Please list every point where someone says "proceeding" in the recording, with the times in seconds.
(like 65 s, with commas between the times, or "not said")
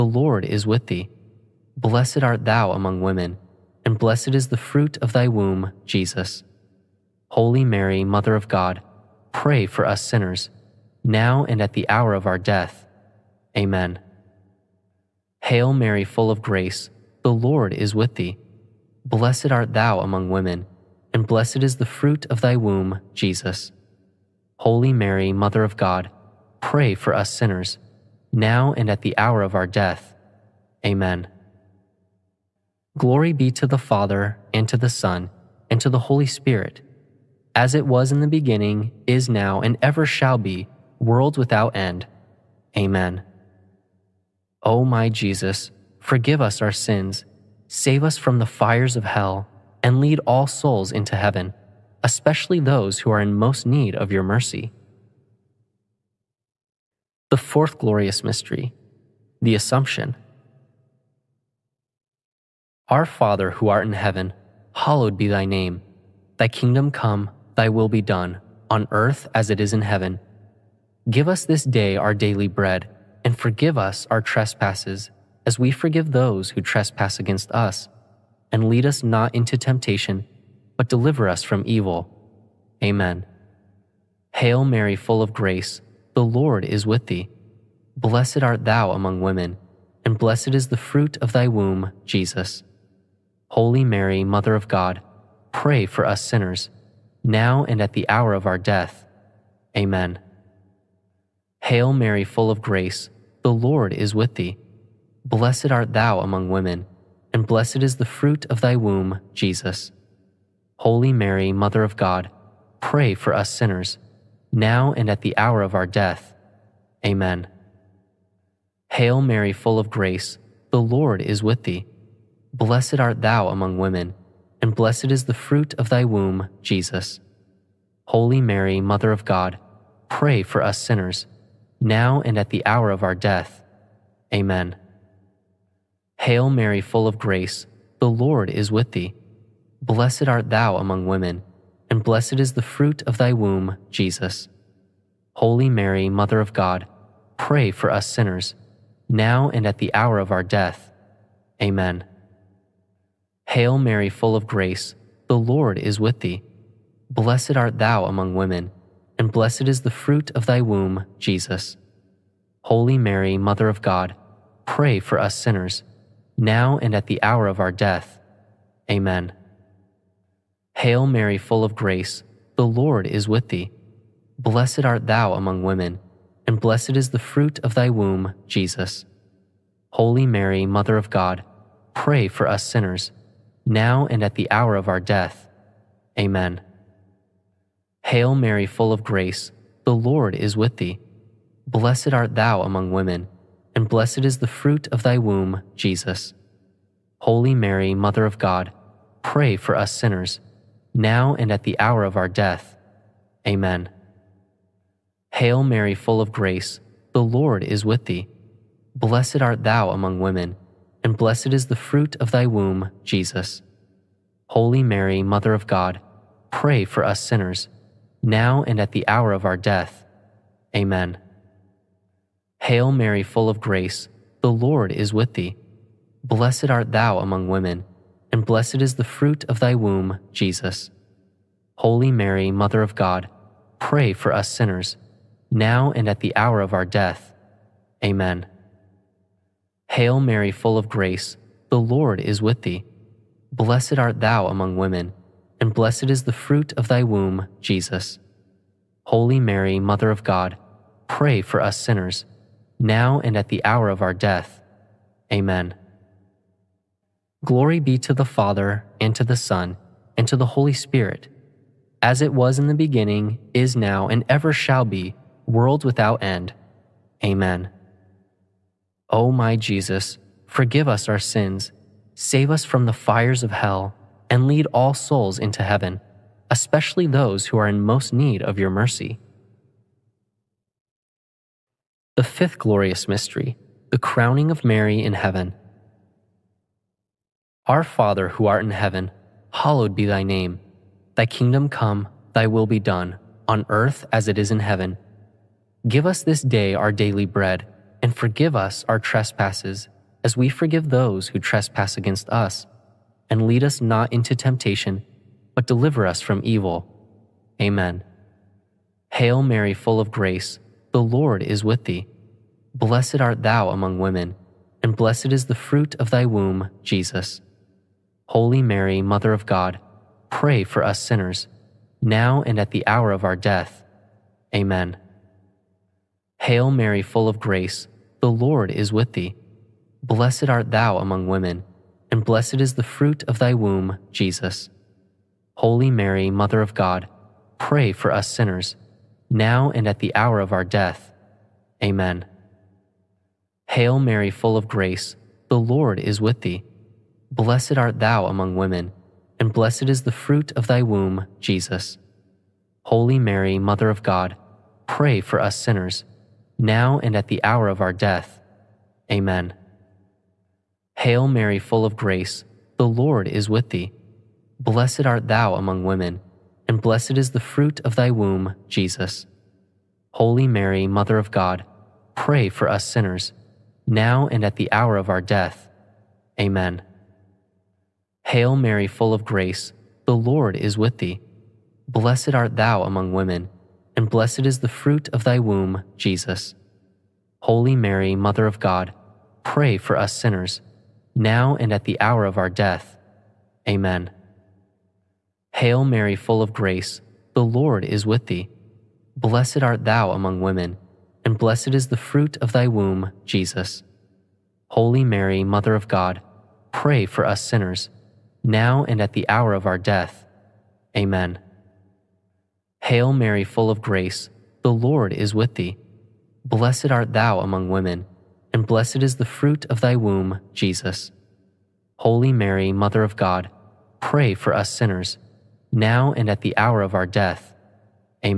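not said.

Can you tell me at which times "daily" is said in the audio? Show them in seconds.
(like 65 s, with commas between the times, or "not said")
72 s, 296 s.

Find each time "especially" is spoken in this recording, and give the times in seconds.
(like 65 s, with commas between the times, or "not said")
52 s, 276 s.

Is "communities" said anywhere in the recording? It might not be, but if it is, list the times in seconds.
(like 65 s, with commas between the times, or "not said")
not said.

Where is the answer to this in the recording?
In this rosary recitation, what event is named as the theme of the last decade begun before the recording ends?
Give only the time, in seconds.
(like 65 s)
283 s.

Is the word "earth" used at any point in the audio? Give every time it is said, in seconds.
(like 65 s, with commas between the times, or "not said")
68 s, 293 s.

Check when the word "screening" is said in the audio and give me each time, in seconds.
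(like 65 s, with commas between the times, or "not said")
not said.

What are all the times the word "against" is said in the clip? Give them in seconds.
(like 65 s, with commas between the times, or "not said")
77 s, 301 s.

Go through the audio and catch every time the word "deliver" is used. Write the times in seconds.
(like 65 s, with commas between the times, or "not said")
80 s, 305 s.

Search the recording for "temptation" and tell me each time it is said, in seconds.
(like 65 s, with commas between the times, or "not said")
79 s, 304 s.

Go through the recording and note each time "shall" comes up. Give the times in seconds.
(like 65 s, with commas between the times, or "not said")
40 s, 264 s.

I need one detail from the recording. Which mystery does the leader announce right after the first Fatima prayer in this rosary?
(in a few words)
the Assumption.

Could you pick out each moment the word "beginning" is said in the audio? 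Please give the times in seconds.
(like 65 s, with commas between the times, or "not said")
38 s, 262 s.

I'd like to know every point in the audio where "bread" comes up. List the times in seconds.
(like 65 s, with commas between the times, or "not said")
72 s, 297 s.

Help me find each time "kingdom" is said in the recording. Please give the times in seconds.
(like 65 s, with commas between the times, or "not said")
66 s, 291 s.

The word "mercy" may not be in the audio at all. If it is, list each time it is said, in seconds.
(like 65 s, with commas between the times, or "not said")
54 s, 278 s.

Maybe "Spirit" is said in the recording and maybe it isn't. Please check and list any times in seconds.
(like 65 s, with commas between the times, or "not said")
36 s, 260 s.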